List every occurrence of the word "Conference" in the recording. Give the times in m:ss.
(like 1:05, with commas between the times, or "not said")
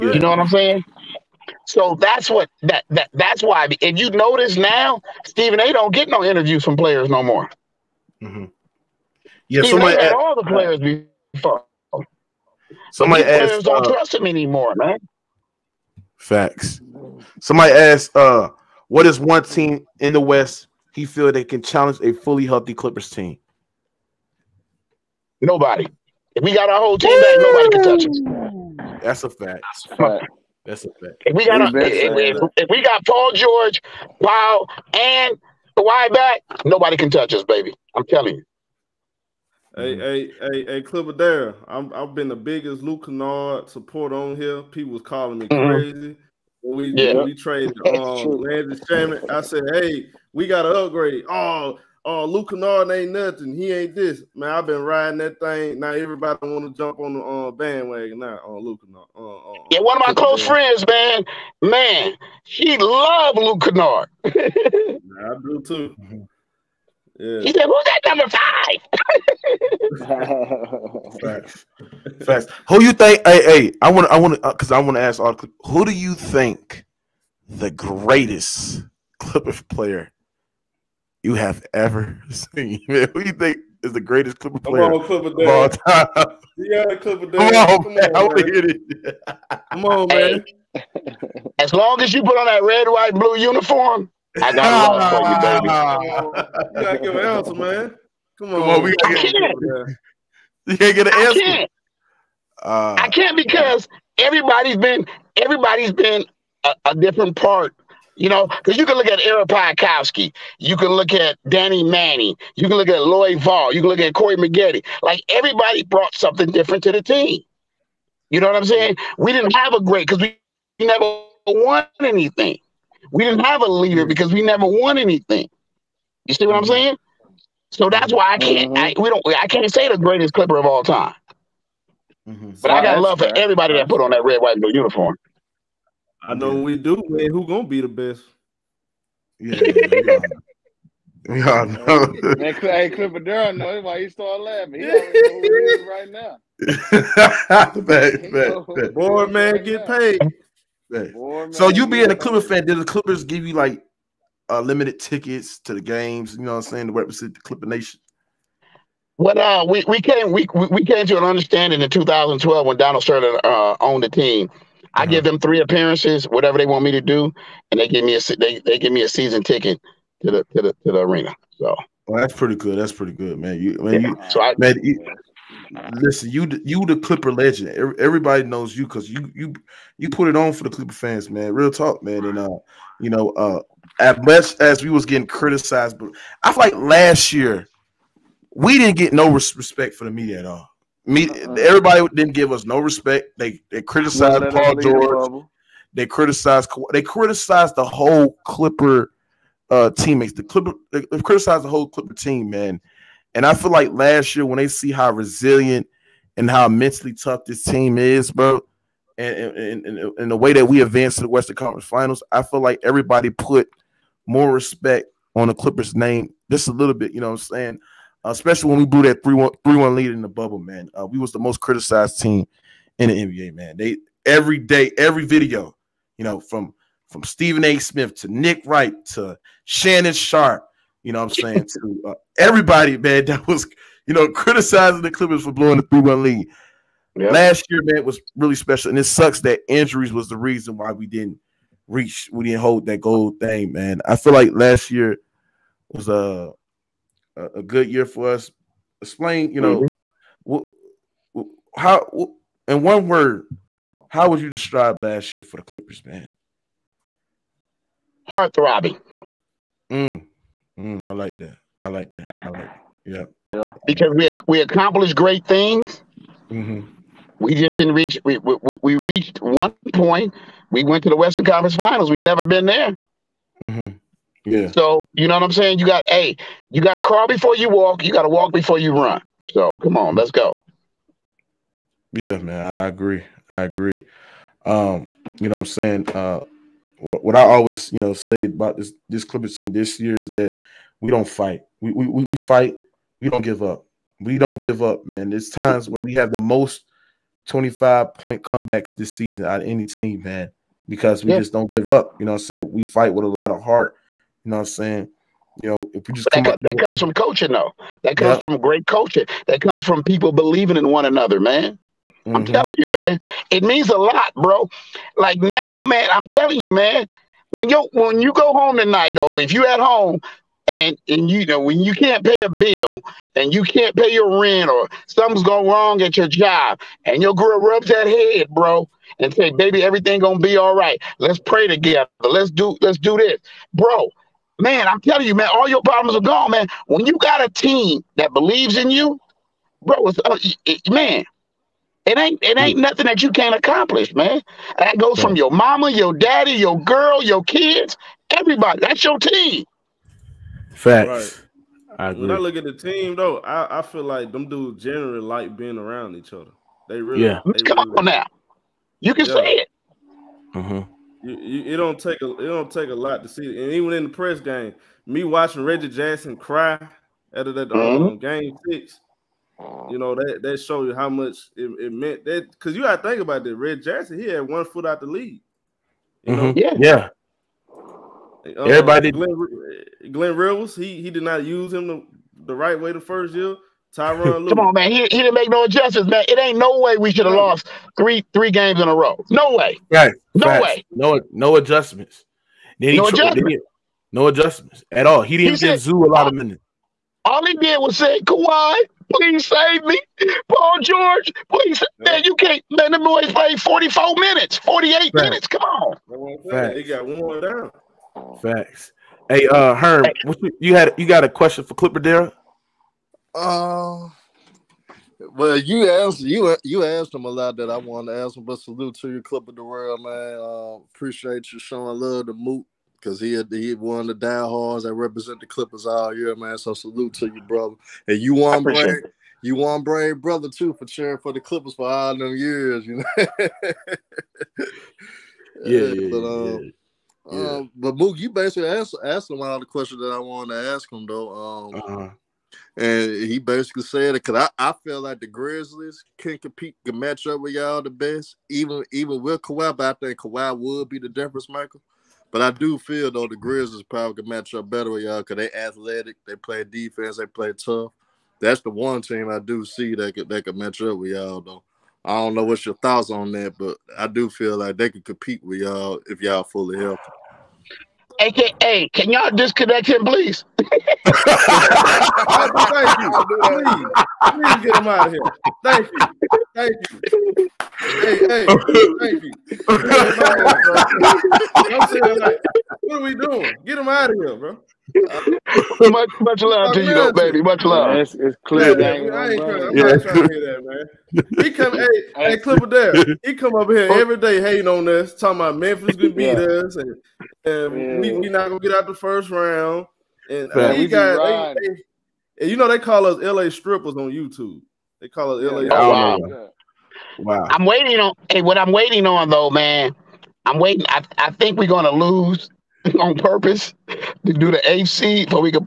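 3:31, 4:31.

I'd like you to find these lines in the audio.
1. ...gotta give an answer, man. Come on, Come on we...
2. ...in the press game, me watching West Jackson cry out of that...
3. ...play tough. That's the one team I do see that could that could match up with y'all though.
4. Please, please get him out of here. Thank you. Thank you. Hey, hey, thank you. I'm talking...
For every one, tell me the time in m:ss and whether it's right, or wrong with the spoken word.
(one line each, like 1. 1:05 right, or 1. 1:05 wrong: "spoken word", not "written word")
1. 1:36 right
2. 6:03 wrong: "Reggie", not "West"
3. 7:37 right
4. 7:53 wrong: "saying", not "talking".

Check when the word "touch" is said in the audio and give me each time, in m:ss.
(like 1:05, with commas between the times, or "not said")
0:27, 0:37.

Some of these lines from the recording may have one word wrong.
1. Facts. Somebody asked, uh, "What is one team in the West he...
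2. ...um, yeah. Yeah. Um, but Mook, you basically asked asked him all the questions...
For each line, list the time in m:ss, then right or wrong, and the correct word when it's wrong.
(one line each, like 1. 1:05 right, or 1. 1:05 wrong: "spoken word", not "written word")
1. 0:16 right
2. 7:16 right.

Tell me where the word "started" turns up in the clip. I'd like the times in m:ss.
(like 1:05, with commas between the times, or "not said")
2:24.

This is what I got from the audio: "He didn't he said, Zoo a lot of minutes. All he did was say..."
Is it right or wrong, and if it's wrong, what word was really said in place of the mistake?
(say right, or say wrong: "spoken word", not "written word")
right.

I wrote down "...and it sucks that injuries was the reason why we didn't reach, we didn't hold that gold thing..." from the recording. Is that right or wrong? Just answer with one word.
right.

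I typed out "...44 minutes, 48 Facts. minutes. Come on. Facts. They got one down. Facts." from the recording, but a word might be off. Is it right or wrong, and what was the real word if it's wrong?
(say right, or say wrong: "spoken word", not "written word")
right.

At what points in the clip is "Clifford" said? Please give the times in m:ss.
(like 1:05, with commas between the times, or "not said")
2:22.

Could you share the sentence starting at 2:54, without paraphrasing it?
you, so I, man, you, listen, you you the Clipper legend.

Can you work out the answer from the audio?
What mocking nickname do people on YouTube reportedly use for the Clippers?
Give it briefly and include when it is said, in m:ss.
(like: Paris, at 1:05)
LA strippers, at 8:23.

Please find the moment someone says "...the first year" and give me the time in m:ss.
6:22.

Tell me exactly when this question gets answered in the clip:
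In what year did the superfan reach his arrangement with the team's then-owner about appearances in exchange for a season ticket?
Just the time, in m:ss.
2:41.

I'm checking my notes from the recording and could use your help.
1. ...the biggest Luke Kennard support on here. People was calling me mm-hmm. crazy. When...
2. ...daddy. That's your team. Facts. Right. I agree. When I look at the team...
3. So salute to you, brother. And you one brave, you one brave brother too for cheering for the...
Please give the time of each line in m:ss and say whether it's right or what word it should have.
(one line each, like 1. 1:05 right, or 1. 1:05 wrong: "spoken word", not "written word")
1. 0:42 right
2. 5:48 wrong: "everybody", not "daddy"
3. 7:06 right.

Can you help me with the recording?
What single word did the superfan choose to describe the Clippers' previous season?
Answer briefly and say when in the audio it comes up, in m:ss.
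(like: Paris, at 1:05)
Heart-throbbing, at 4:18.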